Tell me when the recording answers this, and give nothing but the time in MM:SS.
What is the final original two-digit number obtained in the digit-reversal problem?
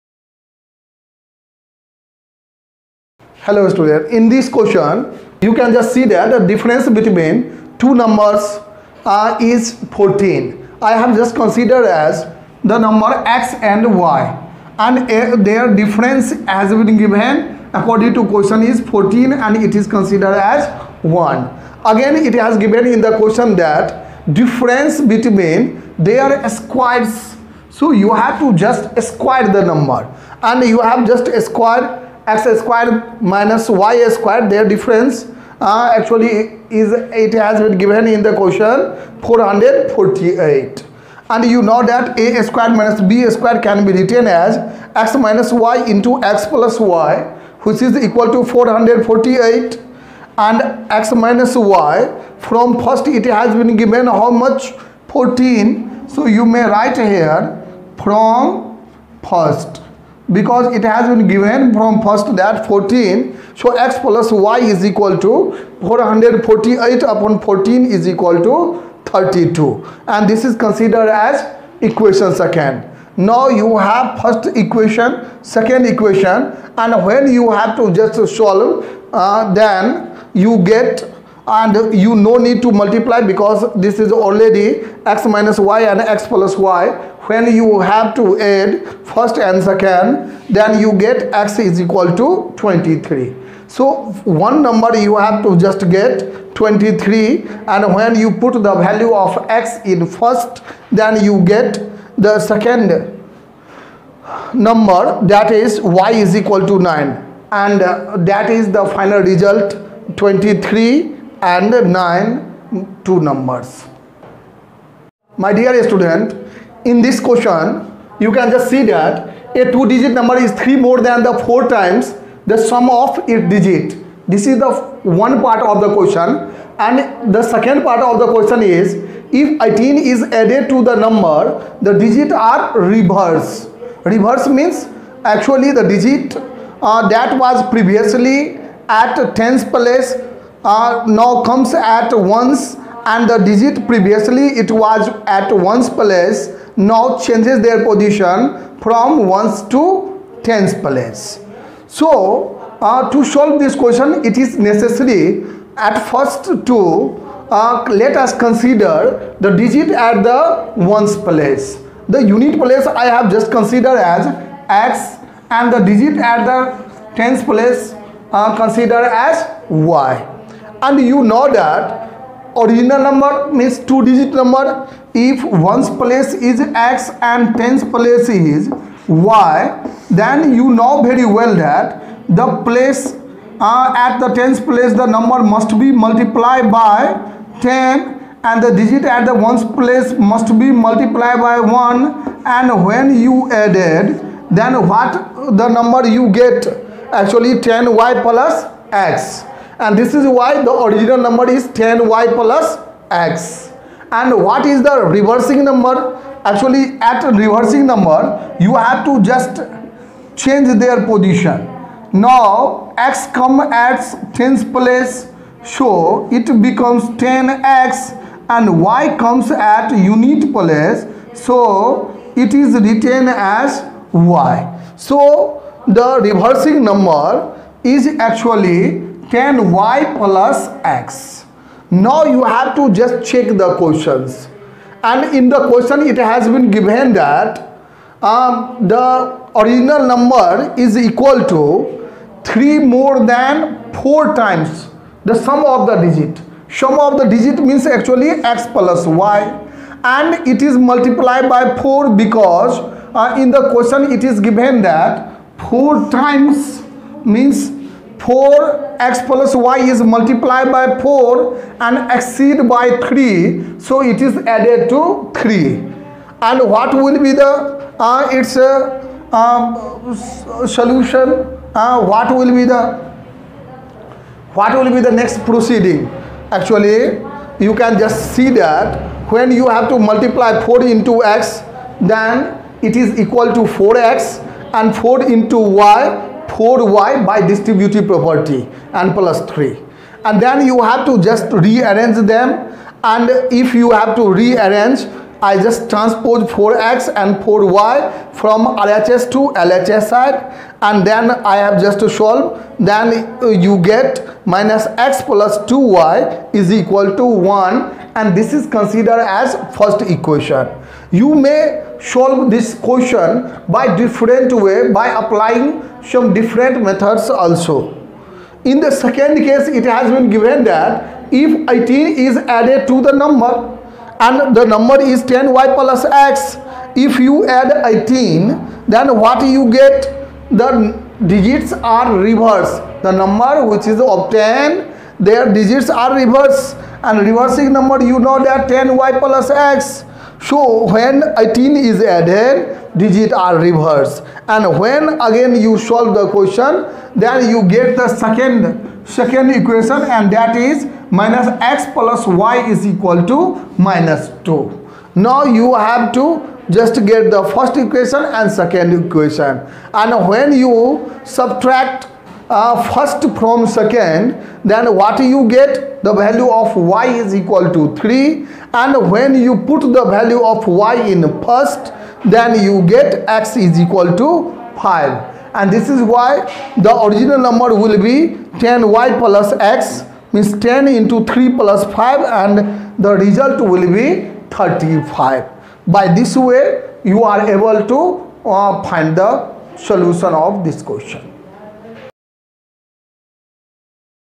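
06:24.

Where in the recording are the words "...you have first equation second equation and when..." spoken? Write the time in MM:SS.
01:13.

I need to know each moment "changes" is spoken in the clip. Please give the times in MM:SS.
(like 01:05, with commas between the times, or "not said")
02:27, 03:30.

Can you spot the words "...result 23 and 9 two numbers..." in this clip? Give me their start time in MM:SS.
01:49.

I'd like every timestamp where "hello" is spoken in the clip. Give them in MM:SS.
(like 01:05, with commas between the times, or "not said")
00:03.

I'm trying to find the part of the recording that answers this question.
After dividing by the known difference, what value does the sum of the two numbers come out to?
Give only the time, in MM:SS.
01:09.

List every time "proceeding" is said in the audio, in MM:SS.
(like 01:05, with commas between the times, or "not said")
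04:35.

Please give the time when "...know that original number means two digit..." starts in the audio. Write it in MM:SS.
02:51.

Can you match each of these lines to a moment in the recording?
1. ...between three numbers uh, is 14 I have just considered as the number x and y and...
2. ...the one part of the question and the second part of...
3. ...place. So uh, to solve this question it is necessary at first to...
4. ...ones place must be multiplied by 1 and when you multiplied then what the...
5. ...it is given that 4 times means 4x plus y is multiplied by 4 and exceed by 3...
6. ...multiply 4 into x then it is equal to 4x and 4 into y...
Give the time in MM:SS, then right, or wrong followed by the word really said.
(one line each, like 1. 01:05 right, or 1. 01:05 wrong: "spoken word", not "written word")
1. 00:06 wrong: "two", not "three"
2. 02:04 right
3. 02:30 right
4. 03:09 wrong: "added", not "multiplied"
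5. 04:14 right
6. 04:39 right.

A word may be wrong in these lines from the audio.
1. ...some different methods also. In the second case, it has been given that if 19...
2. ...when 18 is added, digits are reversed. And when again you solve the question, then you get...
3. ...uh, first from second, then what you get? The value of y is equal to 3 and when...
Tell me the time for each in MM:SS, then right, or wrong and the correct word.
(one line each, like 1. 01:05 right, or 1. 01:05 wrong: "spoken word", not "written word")
1. 05:16 wrong: "18", not "19"
2. 05:40 right
3. 06:02 right.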